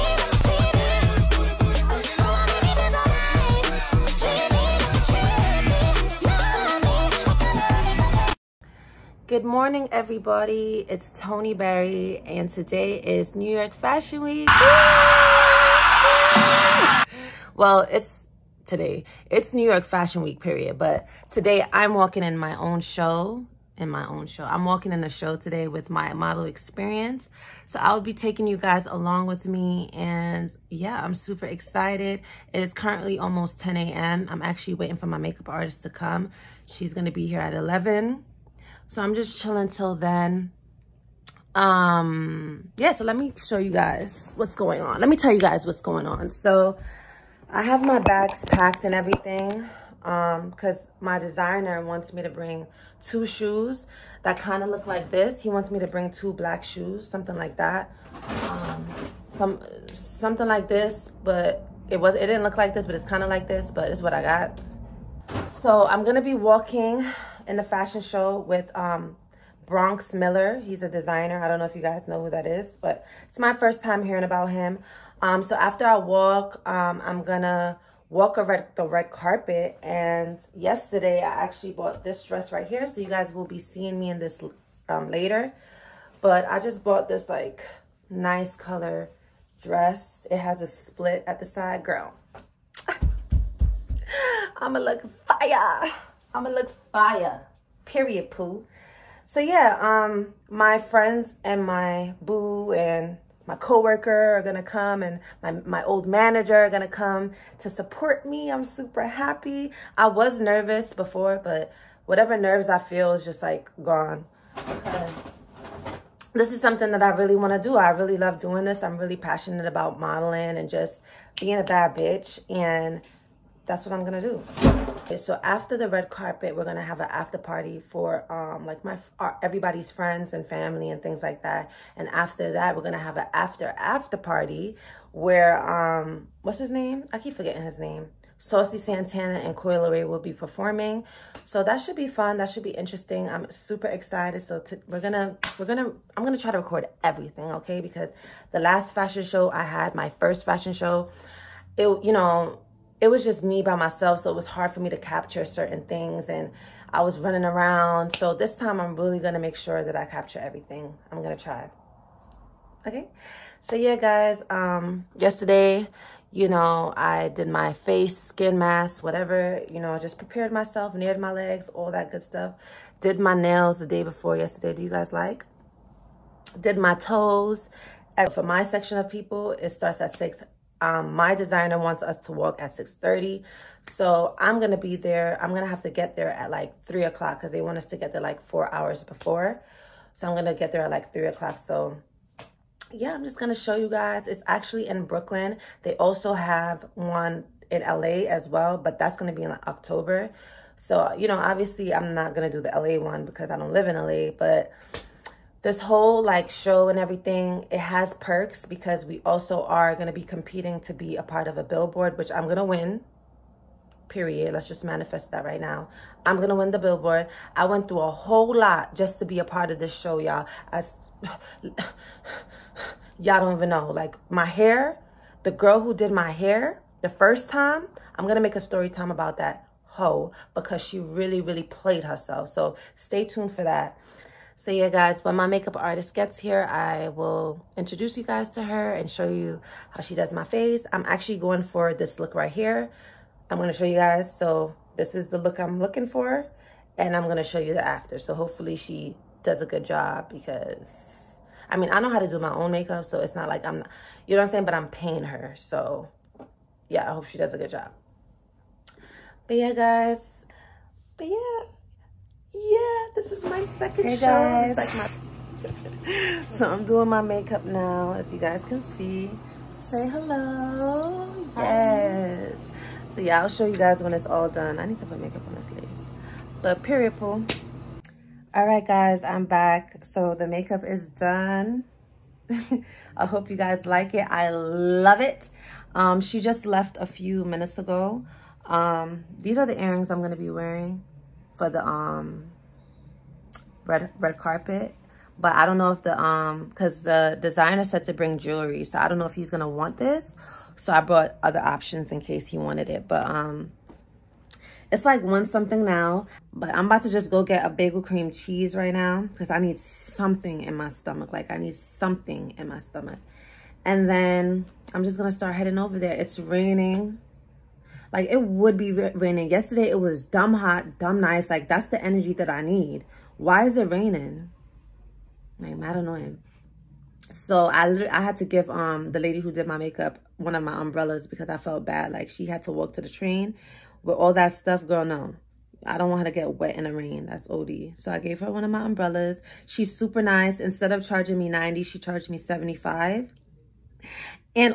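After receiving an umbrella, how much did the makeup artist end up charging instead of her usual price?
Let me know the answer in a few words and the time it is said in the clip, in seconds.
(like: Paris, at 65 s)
75, at 342 s.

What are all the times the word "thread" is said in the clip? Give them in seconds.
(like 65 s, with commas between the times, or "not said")
not said.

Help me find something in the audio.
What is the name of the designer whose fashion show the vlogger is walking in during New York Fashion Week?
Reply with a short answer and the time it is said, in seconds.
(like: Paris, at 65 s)
Bronx Miller, at 69 s.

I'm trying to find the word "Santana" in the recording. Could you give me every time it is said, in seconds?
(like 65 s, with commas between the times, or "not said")
138 s.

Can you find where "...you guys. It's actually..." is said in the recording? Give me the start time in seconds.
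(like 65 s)
193 s.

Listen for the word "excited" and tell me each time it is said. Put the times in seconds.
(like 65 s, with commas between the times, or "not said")
31 s, 143 s.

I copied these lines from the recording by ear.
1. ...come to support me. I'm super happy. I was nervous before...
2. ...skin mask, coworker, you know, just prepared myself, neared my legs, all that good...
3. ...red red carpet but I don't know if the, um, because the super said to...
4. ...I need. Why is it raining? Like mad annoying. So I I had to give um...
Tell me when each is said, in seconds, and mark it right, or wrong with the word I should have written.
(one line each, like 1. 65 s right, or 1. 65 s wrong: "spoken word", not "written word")
1. 106 s right
2. 168 s wrong: "whatever", not "coworker"
3. 293 s wrong: "designer", not "super"
4. 322 s right.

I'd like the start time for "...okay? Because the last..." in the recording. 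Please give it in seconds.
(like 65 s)
147 s.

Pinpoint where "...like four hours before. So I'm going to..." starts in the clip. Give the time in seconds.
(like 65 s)
188 s.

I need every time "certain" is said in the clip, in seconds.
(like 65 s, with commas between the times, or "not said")
155 s.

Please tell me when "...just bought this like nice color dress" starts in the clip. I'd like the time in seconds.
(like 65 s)
86 s.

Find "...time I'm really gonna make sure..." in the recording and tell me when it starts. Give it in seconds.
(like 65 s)
158 s.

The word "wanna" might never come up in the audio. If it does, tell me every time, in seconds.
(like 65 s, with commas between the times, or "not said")
117 s.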